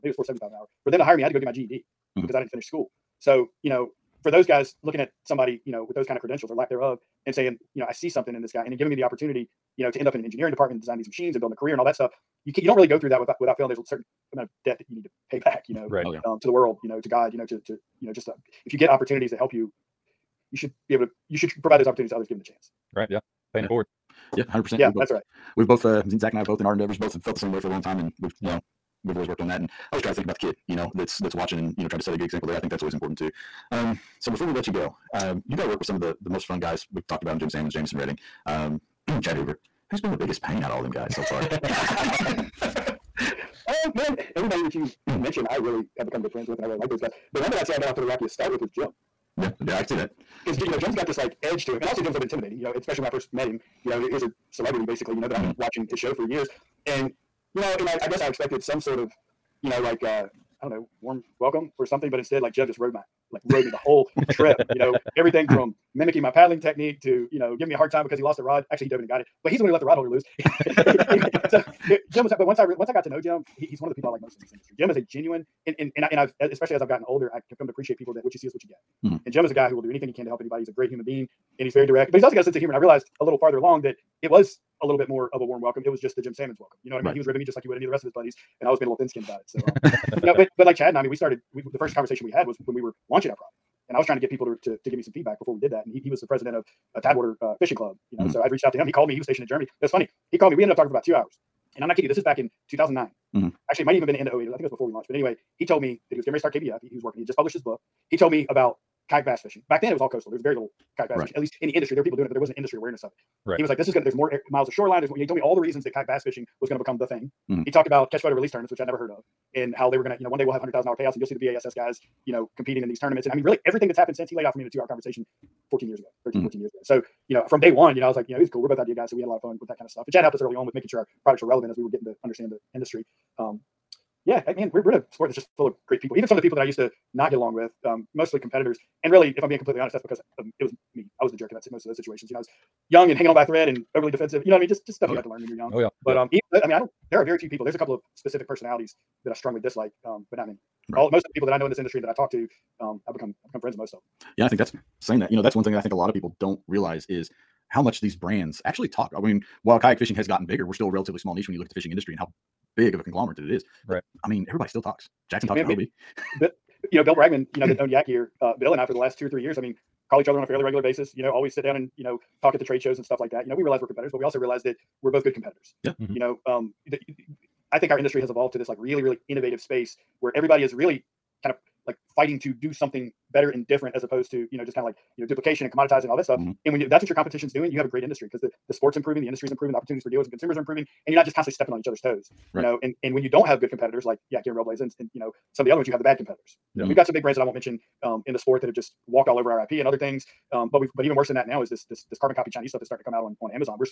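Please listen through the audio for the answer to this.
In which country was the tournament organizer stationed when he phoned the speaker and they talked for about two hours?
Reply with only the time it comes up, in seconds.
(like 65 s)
99 s.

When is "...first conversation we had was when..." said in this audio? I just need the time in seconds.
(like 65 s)
91 s.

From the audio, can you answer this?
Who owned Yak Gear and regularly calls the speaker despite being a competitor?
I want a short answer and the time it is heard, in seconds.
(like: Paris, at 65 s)
Bill Bragman, at 167 s.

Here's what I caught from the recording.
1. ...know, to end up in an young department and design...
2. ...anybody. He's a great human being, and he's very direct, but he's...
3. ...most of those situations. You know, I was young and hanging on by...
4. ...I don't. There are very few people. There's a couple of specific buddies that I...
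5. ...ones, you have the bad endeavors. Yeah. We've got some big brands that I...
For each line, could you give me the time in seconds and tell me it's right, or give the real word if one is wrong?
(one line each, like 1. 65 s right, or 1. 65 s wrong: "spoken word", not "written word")
1. 9 s wrong: "engineering", not "young"
2. 80 s right
3. 141 s right
4. 146 s wrong: "personalities", not "buddies"
5. 195 s wrong: "competitors", not "endeavors".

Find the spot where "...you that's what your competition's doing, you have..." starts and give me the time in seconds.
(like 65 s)
186 s.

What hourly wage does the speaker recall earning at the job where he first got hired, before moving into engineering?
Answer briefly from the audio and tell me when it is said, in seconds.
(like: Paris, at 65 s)
$4.75, at 0 s.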